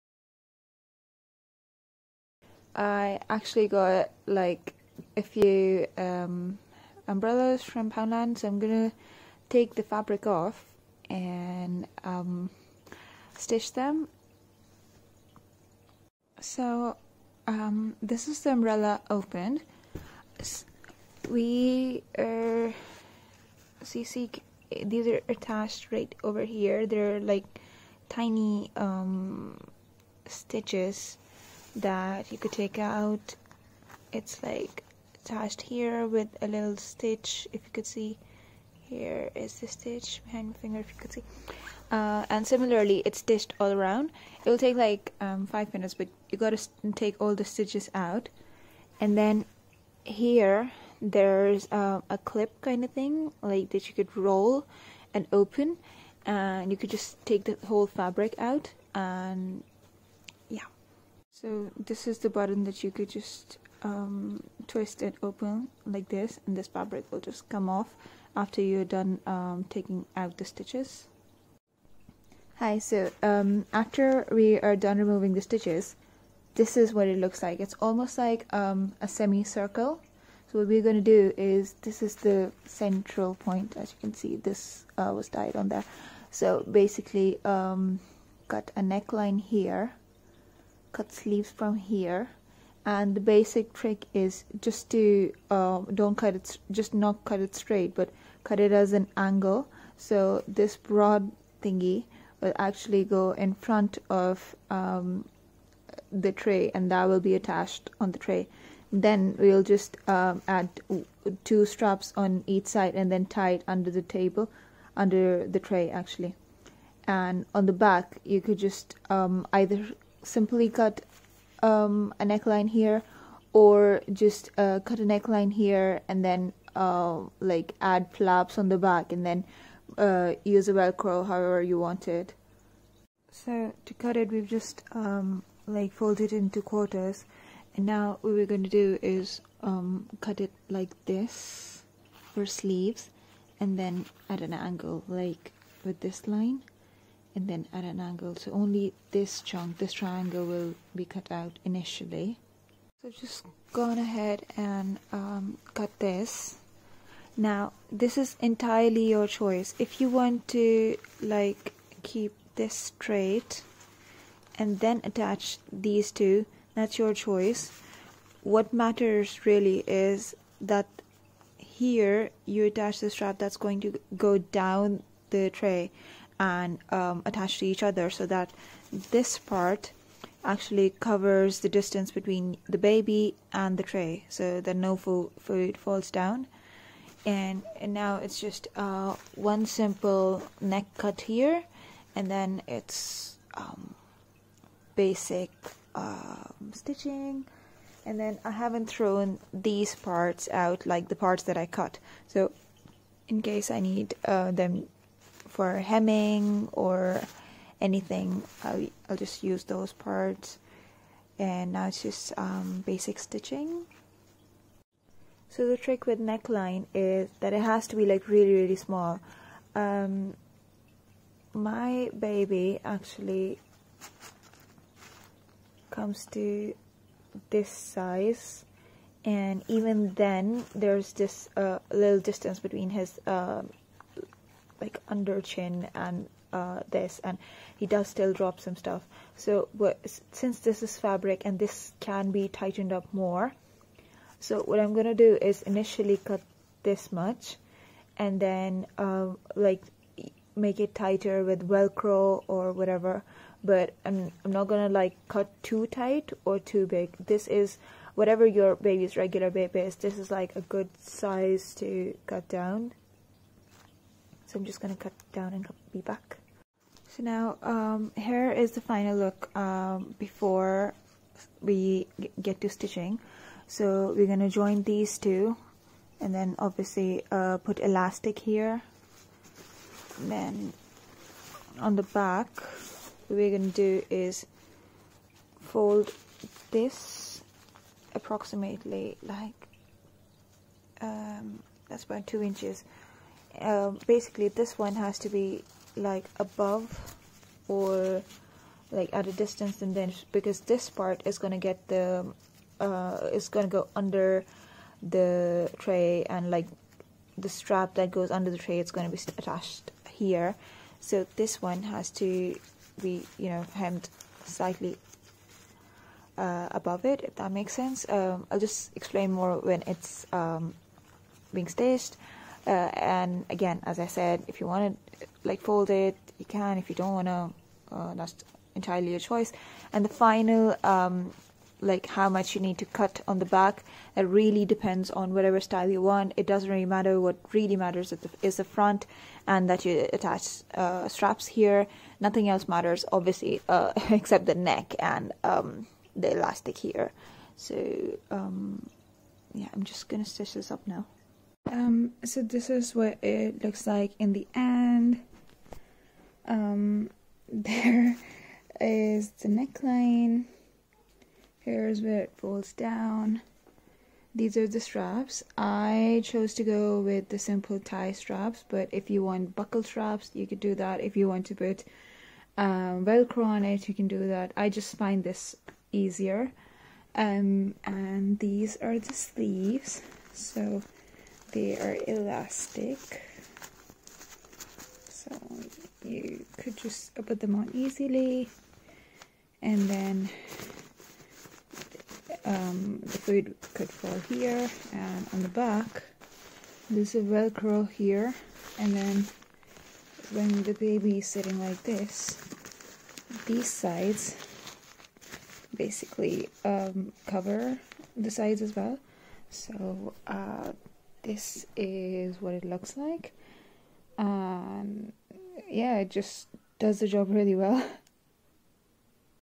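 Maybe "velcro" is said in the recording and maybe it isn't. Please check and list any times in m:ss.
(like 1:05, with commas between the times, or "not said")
2:10, 4:11, 6:13, 6:37.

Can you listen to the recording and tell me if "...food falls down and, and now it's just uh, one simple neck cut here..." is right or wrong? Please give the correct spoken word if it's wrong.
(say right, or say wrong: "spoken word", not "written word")
right.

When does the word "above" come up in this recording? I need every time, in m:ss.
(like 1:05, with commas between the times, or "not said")
4:56, 5:16.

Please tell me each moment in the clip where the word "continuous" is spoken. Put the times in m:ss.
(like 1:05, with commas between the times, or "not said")
not said.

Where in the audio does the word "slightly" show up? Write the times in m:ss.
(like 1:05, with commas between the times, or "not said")
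5:14.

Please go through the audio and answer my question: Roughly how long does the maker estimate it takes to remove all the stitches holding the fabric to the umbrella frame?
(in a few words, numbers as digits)
5 minutes.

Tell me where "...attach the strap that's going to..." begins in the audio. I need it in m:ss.
2:52.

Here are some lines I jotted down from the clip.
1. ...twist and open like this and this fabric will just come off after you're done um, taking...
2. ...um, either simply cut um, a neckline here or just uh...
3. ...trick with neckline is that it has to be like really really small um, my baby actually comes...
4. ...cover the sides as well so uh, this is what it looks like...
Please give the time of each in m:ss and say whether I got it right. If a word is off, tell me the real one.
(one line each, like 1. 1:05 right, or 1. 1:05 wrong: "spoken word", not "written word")
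1. 1:04 right
2. 1:59 right
3. 3:35 right
4. 6:47 right.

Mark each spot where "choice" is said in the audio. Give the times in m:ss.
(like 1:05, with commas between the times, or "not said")
2:39, 2:47, 5:29.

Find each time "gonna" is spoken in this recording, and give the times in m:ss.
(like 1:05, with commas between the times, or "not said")
0:08, 4:04, 4:14, 5:50.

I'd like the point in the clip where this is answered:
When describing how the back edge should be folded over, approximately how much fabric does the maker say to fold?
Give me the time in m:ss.
4:52.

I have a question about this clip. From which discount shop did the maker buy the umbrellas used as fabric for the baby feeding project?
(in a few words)
Poundland.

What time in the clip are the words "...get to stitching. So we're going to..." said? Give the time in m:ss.
4:32.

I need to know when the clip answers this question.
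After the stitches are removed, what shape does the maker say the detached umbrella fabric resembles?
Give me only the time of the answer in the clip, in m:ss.
1:19.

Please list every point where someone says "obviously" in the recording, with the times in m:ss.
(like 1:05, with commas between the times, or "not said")
4:36, 5:43.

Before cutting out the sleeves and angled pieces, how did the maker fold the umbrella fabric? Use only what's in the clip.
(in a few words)
Into quarters.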